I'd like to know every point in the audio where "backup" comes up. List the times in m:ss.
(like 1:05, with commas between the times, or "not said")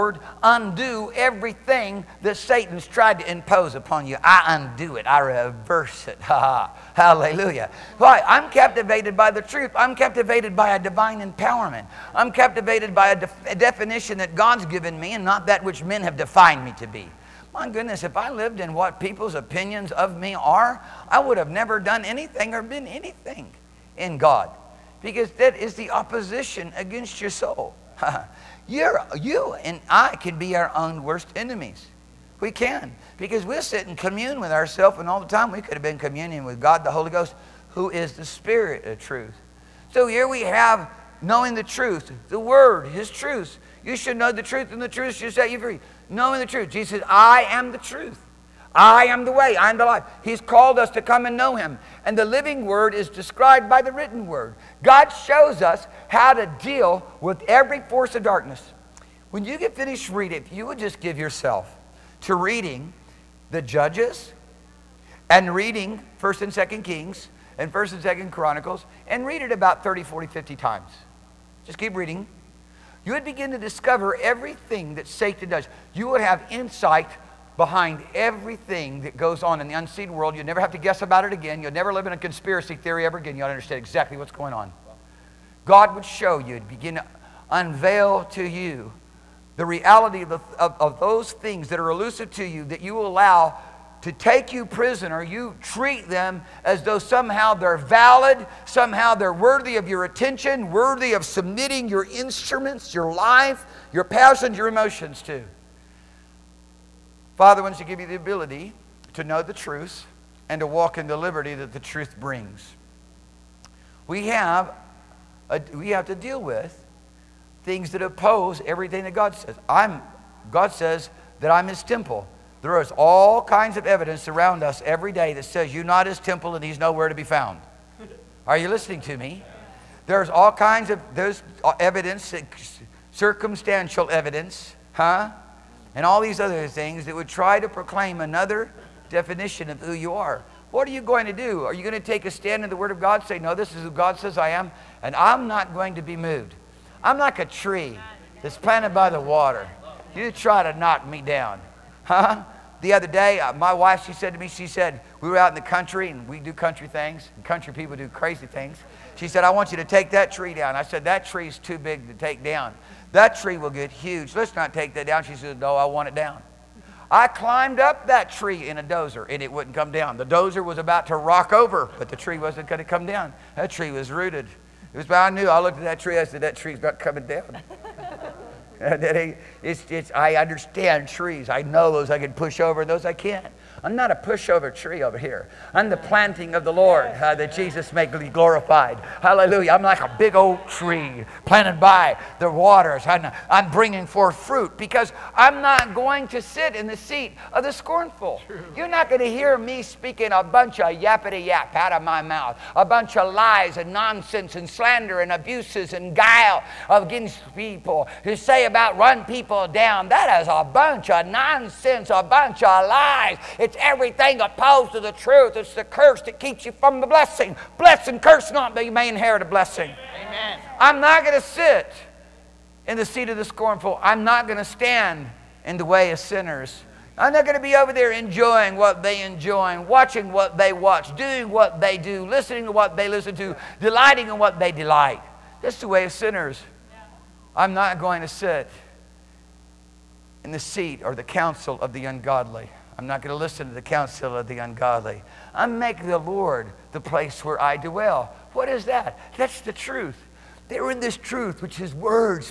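not said.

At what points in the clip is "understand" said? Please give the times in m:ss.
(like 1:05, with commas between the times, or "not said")
1:23, 3:00.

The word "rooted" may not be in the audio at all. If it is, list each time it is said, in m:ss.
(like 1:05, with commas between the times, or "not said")
2:54.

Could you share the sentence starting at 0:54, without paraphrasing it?
God shows us how to deal with every force of darkness.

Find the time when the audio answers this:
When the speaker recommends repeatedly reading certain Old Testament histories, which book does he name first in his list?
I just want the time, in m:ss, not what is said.
1:03.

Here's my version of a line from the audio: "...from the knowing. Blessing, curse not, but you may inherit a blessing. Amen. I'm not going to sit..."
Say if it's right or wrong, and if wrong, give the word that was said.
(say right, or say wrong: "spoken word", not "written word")
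wrong: "blessing", not "knowing".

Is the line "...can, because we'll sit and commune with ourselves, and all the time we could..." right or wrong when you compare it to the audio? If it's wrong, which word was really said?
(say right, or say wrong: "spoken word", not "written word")
right.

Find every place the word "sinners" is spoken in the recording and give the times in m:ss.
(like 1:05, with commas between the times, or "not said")
3:46, 3:56.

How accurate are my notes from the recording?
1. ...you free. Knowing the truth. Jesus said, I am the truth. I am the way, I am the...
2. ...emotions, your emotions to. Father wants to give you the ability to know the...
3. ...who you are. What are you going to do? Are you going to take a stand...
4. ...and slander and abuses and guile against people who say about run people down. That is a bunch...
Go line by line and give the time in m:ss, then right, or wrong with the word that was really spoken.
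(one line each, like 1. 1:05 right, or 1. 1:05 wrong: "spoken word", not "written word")
1. 0:45 right
2. 1:44 wrong: "passions", not "emotions"
3. 2:19 right
4. 3:24 right.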